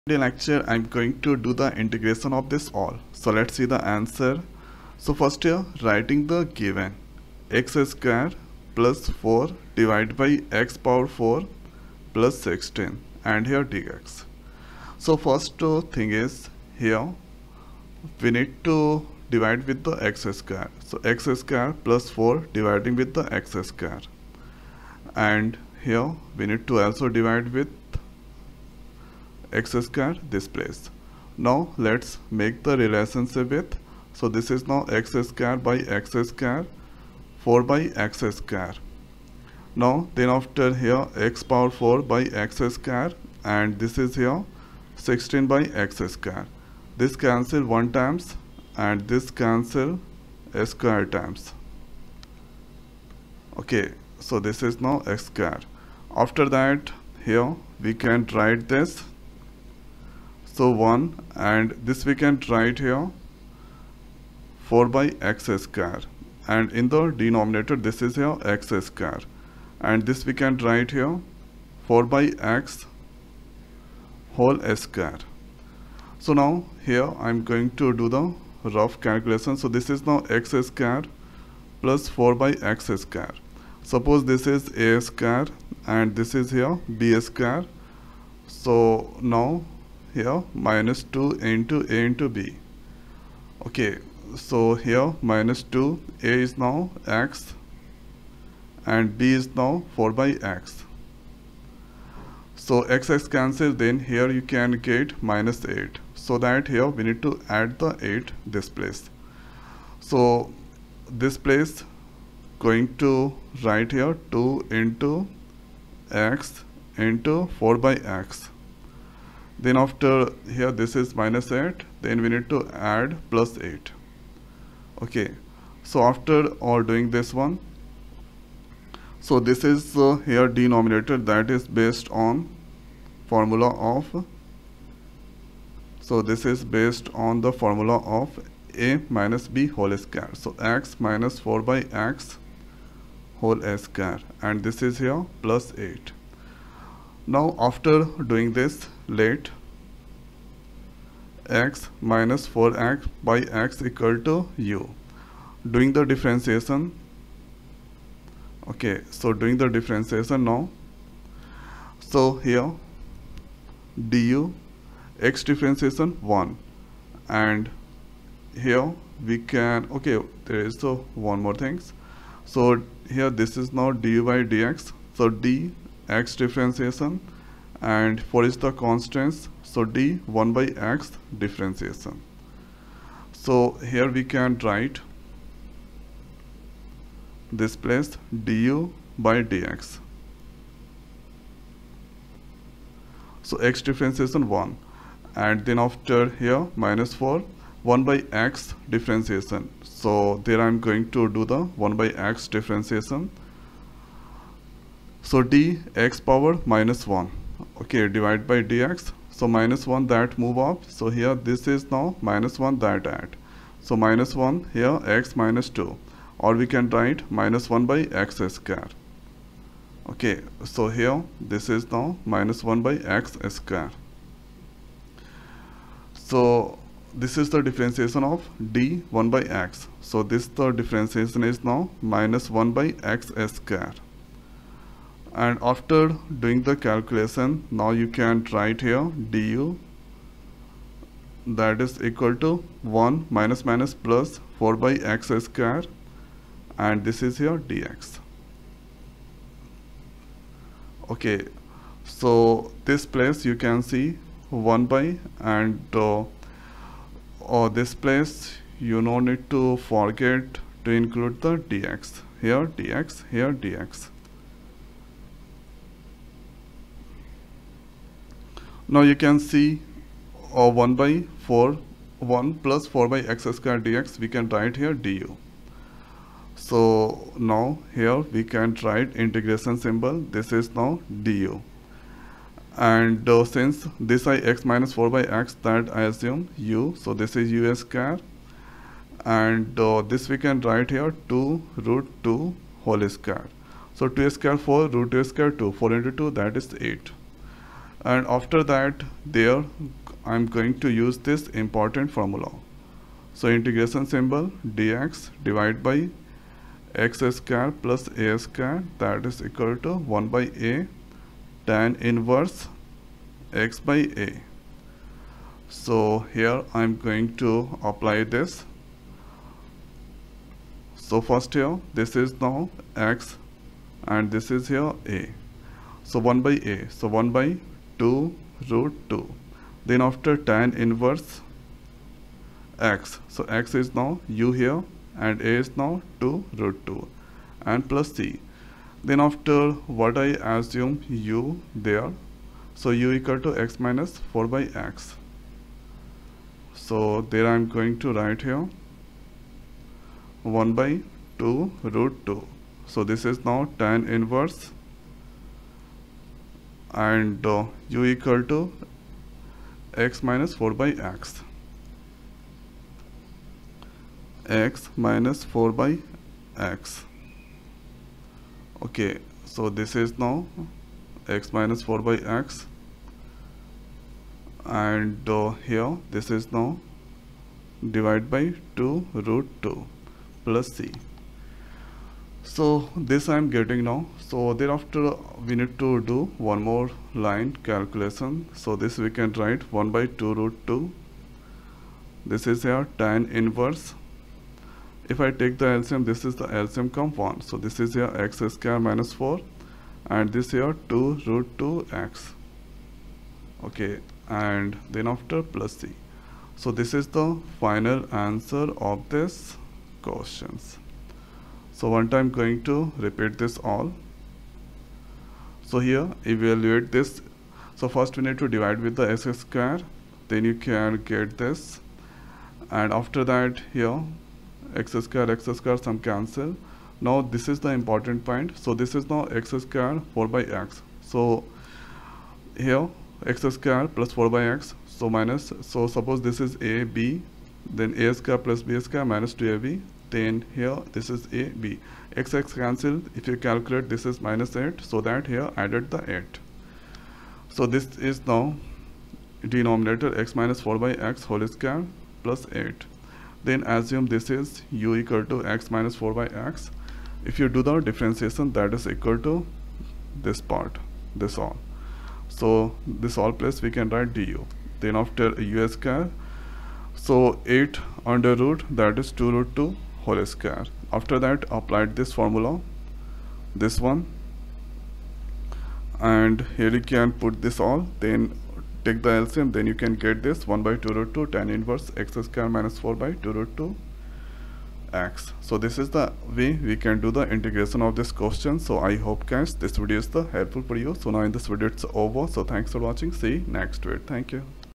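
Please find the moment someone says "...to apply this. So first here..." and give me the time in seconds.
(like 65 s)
317 s.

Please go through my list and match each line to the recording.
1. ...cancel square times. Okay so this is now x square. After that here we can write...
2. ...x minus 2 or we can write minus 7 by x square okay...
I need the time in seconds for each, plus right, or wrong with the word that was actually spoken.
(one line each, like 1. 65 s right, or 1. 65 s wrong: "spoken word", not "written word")
1. 49 s right
2. 215 s wrong: "1", not "7".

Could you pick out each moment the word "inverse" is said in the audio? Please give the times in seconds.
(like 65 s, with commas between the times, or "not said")
311 s, 330 s, 354 s, 393 s, 481 s.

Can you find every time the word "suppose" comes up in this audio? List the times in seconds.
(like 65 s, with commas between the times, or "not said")
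83 s, 435 s.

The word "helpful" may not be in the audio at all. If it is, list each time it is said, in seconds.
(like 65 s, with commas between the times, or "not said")
490 s.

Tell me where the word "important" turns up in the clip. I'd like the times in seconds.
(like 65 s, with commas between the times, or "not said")
301 s, 427 s.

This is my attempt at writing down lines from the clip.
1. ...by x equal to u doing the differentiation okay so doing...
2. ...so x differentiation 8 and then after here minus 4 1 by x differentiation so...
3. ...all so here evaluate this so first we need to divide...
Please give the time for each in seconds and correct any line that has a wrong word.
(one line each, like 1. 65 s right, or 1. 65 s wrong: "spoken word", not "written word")
1. 153 s right
2. 193 s wrong: "1", not "8"
3. 413 s right.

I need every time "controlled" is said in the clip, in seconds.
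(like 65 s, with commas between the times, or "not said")
not said.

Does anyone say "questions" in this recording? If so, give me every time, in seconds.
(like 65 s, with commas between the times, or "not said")
410 s, 488 s.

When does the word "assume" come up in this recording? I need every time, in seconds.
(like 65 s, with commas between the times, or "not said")
286 s, 340 s, 453 s.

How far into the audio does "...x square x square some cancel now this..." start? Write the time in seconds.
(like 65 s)
424 s.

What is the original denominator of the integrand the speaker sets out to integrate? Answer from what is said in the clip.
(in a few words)
x^4 + 16.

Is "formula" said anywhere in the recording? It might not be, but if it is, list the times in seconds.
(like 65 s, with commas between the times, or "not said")
133 s, 137 s, 302 s, 472 s.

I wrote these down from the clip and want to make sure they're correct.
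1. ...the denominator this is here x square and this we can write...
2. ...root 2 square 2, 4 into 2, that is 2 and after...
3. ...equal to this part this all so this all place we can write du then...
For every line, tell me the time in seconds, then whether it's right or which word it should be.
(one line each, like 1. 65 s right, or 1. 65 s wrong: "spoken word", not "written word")
1. 66 s right
2. 294 s wrong: "8", not "2"
3. 458 s right.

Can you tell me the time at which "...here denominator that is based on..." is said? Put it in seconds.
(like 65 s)
130 s.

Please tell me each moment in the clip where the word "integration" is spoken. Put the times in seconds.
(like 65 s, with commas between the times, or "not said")
1 s, 279 s, 303 s, 487 s.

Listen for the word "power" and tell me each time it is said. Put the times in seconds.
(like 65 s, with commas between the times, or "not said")
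10 s, 41 s, 206 s.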